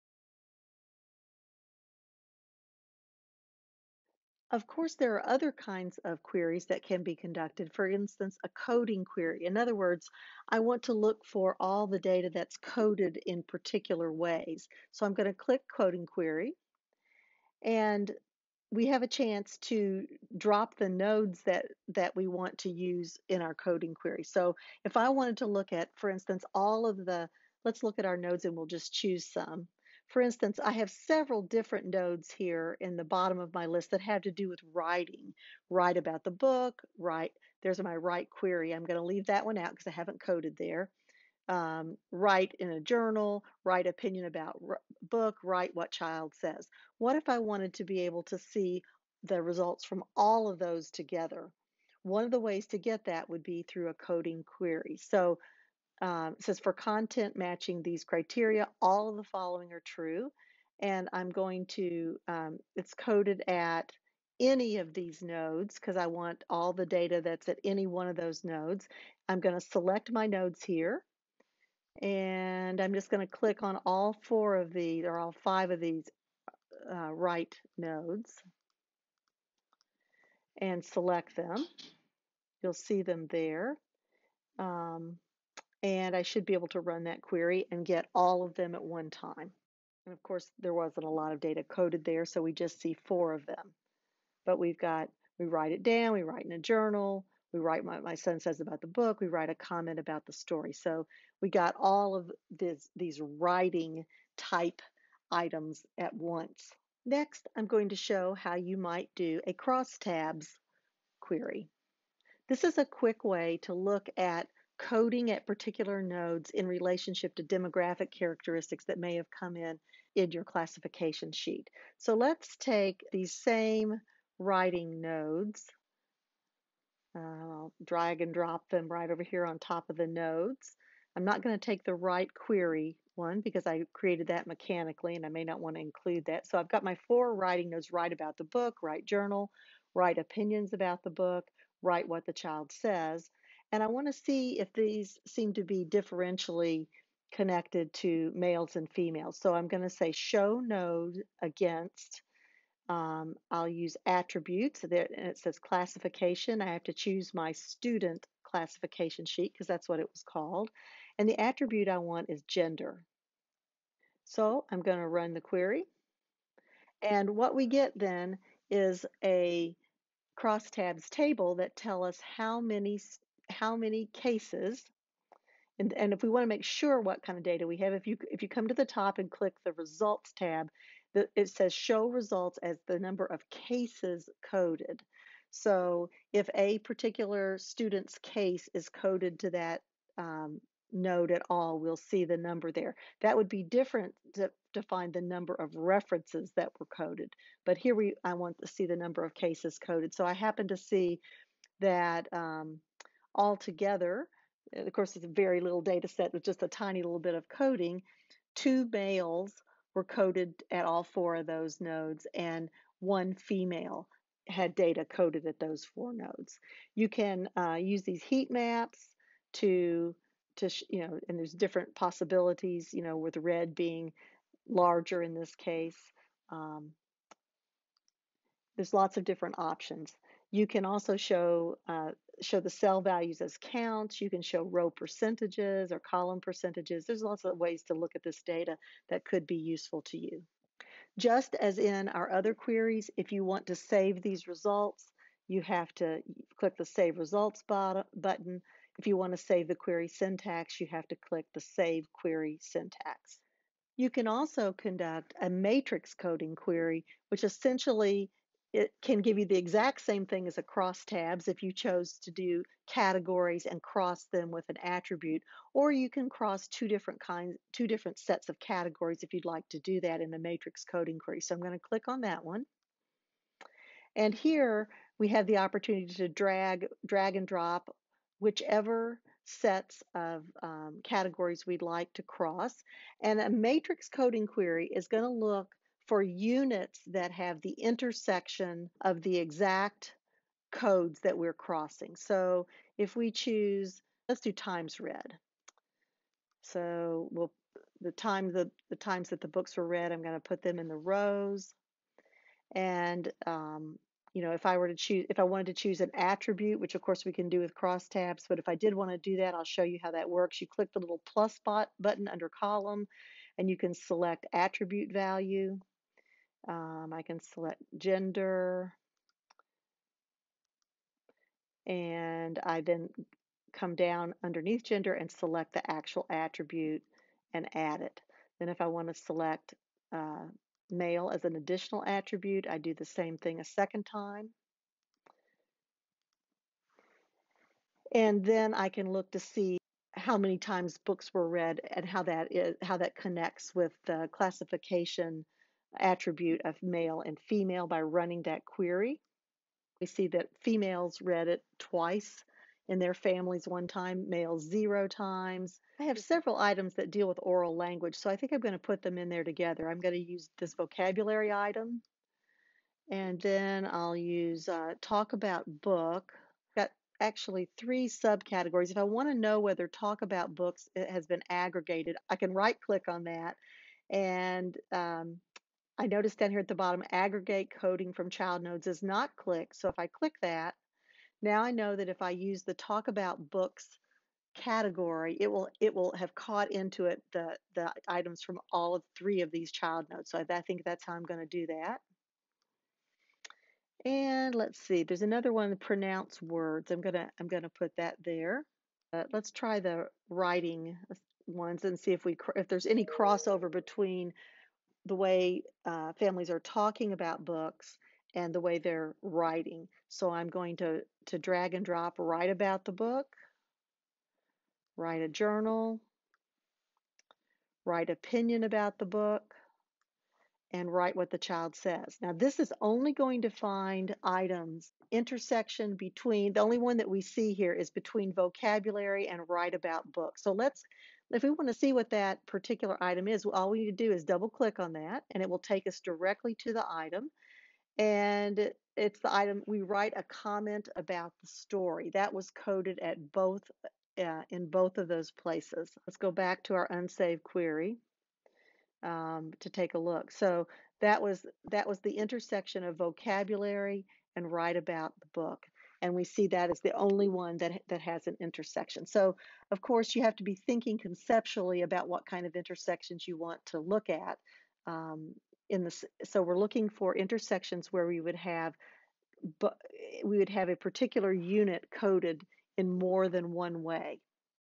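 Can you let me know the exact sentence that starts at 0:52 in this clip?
One of the ways to get that would be through a coding query.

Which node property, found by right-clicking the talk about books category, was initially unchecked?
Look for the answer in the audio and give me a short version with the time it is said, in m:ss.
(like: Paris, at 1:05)
aggregate coding from child nodes, at 6:17.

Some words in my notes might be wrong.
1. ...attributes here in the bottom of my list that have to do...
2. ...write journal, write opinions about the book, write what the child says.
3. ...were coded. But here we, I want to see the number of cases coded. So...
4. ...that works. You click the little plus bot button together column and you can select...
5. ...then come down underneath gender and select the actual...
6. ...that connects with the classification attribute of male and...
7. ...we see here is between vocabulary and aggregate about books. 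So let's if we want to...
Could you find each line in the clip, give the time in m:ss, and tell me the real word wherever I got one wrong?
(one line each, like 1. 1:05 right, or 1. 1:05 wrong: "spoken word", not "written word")
1. 0:31 wrong: "nodes", not "attributes"
2. 2:18 right
3. 3:16 right
4. 5:10 wrong: "under", not "together"
5. 5:22 right
6. 5:42 right
7. 7:07 wrong: "write", not "aggregate".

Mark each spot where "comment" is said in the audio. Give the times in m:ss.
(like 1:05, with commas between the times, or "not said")
1:39, 7:20.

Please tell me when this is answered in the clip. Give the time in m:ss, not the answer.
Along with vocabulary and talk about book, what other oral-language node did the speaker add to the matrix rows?
6:35.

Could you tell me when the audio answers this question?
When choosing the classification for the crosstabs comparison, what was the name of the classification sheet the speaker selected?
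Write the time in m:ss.
2:37.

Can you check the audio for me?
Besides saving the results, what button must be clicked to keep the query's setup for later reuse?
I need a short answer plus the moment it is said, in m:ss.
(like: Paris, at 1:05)
Save Query Syntax, at 4:11.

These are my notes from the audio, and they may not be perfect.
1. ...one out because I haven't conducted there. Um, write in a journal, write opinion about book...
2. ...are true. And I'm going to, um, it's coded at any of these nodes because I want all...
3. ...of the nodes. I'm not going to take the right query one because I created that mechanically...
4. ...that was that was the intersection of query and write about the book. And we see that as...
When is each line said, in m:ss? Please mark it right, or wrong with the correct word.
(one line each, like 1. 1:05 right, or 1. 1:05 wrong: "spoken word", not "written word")
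1. 0:39 wrong: "coded", not "conducted"
2. 0:59 right
3. 2:09 right
4. 7:31 wrong: "vocabulary", not "query".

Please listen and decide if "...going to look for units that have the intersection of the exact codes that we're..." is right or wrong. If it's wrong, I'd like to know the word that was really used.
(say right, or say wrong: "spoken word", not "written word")
right.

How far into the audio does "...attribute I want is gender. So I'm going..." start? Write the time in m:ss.
2:41.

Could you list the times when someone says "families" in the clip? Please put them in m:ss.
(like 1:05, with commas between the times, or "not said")
5:53, 6:46.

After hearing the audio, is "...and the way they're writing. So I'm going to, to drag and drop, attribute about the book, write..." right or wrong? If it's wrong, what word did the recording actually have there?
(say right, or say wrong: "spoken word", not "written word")
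wrong: "write", not "attribute".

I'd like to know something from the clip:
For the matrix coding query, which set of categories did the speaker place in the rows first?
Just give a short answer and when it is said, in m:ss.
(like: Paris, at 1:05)
times read, at 4:54.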